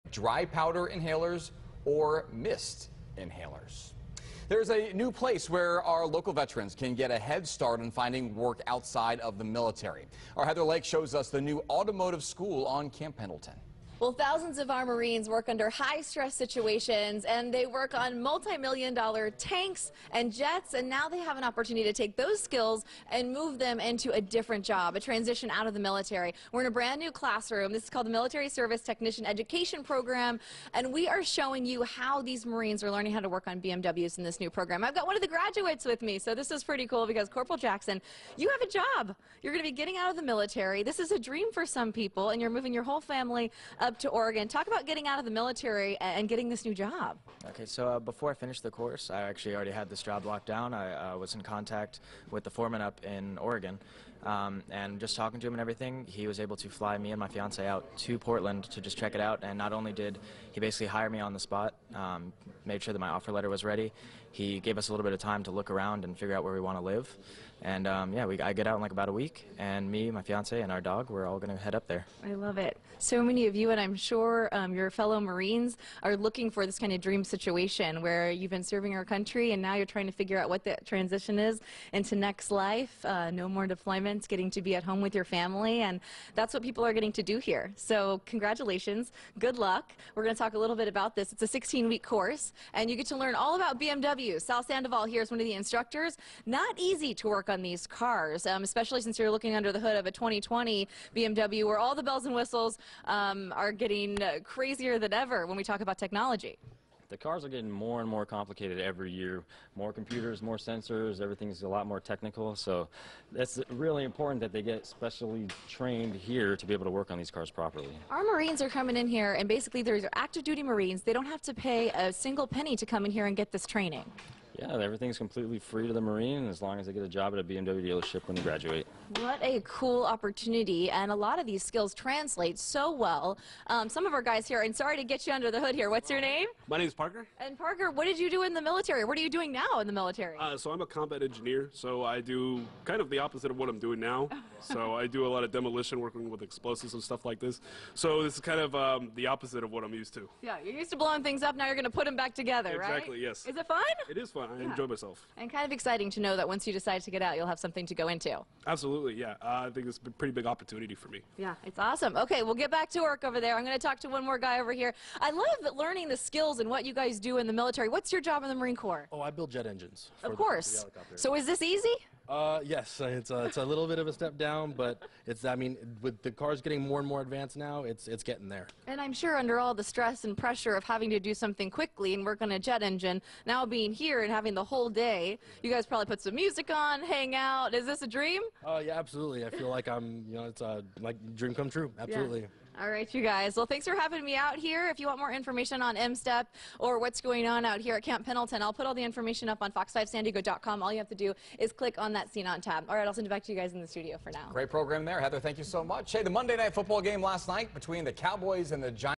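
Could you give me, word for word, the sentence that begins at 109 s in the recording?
More computers, more sensors, everything's a lot more technical.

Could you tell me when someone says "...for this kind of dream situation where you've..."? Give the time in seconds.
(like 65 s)
76 s.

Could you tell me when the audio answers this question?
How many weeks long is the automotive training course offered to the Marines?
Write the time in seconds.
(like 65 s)
91 s.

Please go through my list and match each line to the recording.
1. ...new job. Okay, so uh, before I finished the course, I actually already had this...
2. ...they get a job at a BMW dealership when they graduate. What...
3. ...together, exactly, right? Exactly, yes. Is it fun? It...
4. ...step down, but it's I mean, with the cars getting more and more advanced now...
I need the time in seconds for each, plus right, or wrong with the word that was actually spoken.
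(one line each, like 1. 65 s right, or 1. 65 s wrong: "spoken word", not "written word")
1. 46 s right
2. 126 s right
3. 152 s right
4. 174 s right.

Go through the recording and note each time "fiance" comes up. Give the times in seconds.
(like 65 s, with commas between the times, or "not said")
57 s, 70 s.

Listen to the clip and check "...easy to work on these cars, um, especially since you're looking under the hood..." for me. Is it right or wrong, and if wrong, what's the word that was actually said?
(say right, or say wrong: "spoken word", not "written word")
right.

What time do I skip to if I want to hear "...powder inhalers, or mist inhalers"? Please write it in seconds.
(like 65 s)
0 s.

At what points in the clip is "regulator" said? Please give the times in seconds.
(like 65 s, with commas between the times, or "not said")
not said.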